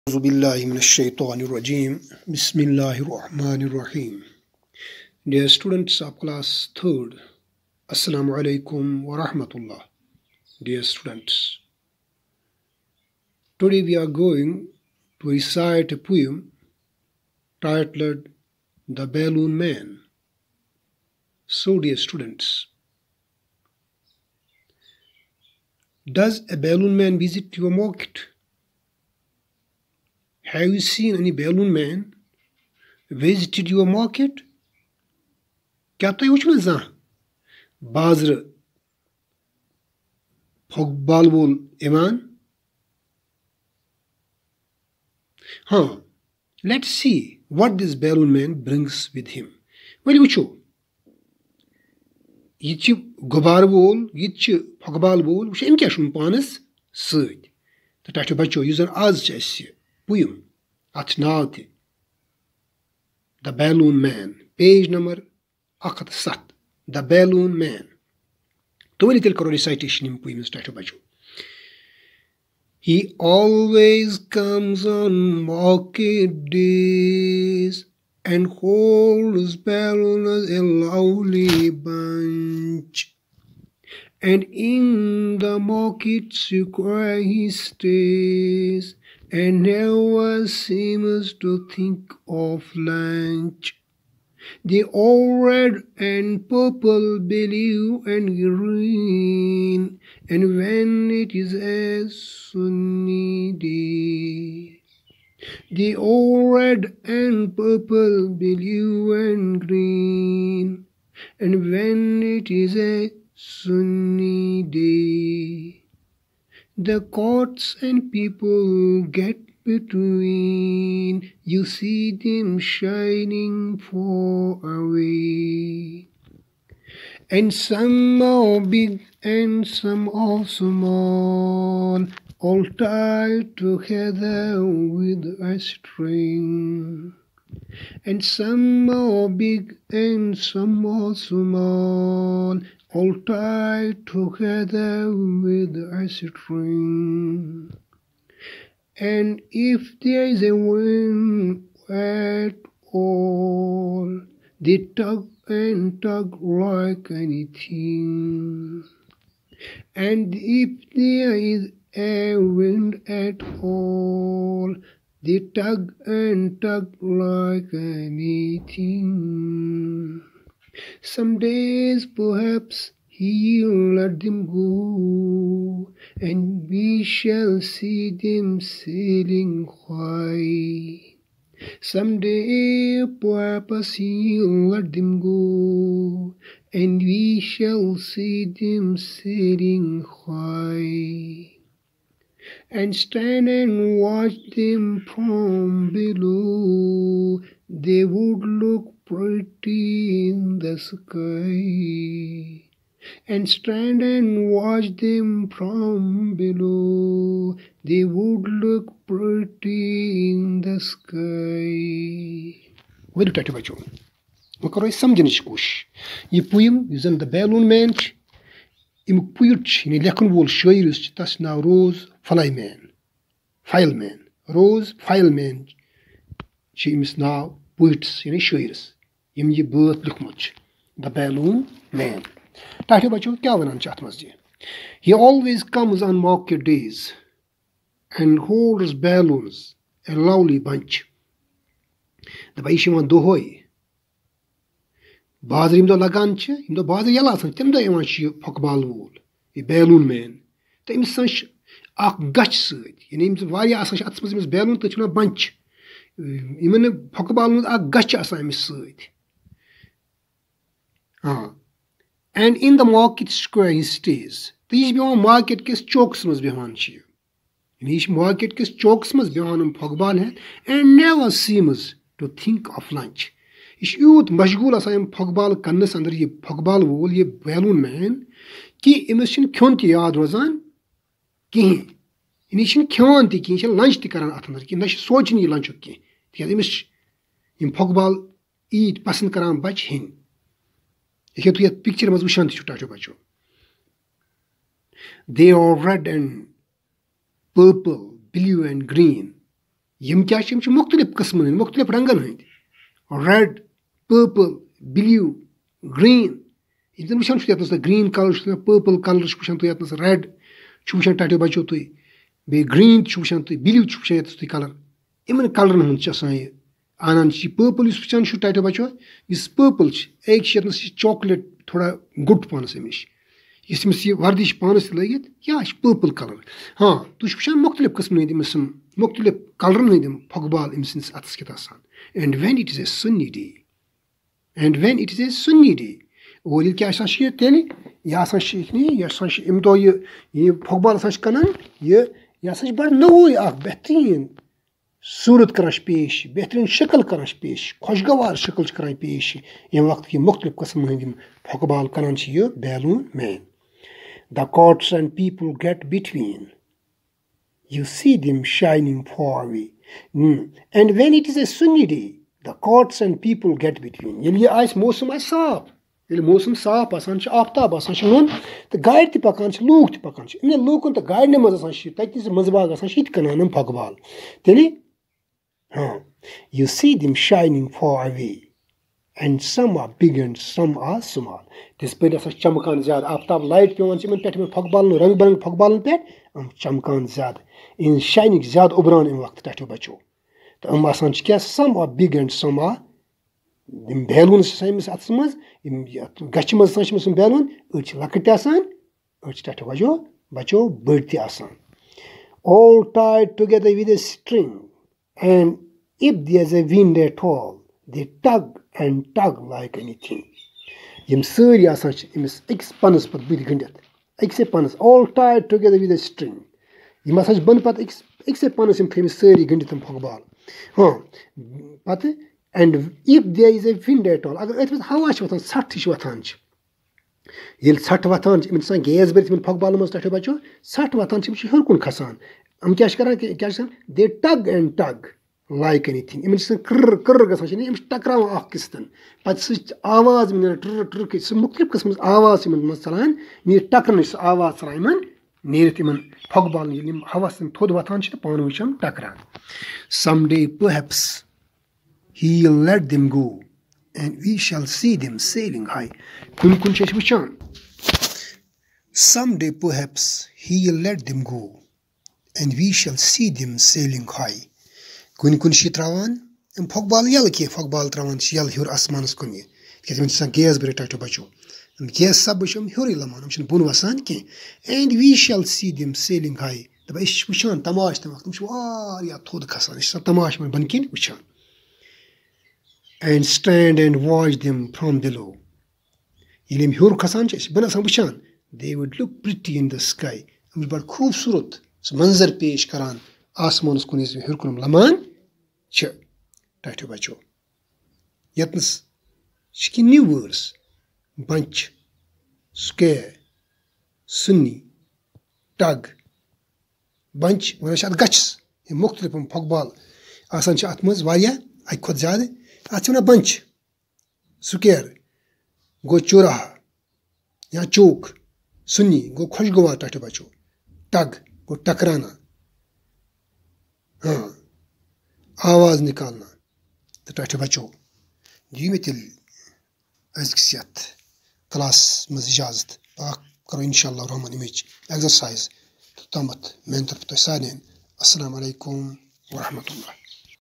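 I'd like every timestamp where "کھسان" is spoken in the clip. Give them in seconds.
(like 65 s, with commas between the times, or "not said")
431 s, 479 s, 487 s.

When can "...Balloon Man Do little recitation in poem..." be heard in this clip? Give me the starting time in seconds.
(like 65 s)
67 s.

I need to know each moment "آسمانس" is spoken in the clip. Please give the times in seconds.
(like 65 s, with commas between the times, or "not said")
468 s, 493 s.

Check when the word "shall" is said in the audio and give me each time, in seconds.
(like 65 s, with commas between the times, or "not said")
177 s, 187 s, 462 s.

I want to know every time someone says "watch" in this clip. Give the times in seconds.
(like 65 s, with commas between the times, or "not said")
193 s, 204 s.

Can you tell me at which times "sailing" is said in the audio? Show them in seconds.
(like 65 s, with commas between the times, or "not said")
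178 s, 188 s, 463 s.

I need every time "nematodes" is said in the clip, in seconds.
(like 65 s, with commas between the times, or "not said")
not said.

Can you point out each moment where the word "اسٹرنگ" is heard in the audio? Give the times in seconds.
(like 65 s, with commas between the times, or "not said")
403 s, 416 s.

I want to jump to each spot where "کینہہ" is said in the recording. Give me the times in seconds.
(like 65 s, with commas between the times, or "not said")
285 s, 467 s, 474 s, 499 s.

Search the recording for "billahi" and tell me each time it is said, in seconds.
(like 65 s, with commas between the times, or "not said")
0 s.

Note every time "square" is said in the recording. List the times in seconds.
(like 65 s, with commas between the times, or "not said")
86 s, 263 s.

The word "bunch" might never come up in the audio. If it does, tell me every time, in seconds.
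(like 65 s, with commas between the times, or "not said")
81 s.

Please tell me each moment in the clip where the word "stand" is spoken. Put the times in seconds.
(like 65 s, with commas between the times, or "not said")
192 s, 203 s.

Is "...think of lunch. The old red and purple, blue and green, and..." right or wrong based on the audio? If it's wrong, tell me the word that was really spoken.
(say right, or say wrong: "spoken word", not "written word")
right.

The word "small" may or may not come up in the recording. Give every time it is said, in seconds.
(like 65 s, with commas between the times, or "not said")
130 s, 141 s.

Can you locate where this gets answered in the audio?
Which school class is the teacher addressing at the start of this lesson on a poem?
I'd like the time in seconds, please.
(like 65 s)
6 s.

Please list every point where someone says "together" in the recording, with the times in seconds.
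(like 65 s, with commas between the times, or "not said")
133 s, 144 s.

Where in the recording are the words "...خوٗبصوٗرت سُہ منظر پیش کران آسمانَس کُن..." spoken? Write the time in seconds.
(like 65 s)
490 s.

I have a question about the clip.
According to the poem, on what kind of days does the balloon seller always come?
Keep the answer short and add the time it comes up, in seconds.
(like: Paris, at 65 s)
market days, at 75 s.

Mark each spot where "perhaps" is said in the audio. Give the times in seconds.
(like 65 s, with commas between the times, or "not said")
172 s, 183 s.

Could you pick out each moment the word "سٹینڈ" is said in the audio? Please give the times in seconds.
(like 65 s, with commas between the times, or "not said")
483 s.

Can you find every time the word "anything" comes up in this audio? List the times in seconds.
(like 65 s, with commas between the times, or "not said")
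157 s, 167 s, 409 s.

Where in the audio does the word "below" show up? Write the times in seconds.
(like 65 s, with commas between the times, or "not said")
195 s, 206 s.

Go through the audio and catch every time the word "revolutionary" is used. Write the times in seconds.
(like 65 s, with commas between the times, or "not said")
not said.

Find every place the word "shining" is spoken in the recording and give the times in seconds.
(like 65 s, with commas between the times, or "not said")
122 s, 377 s.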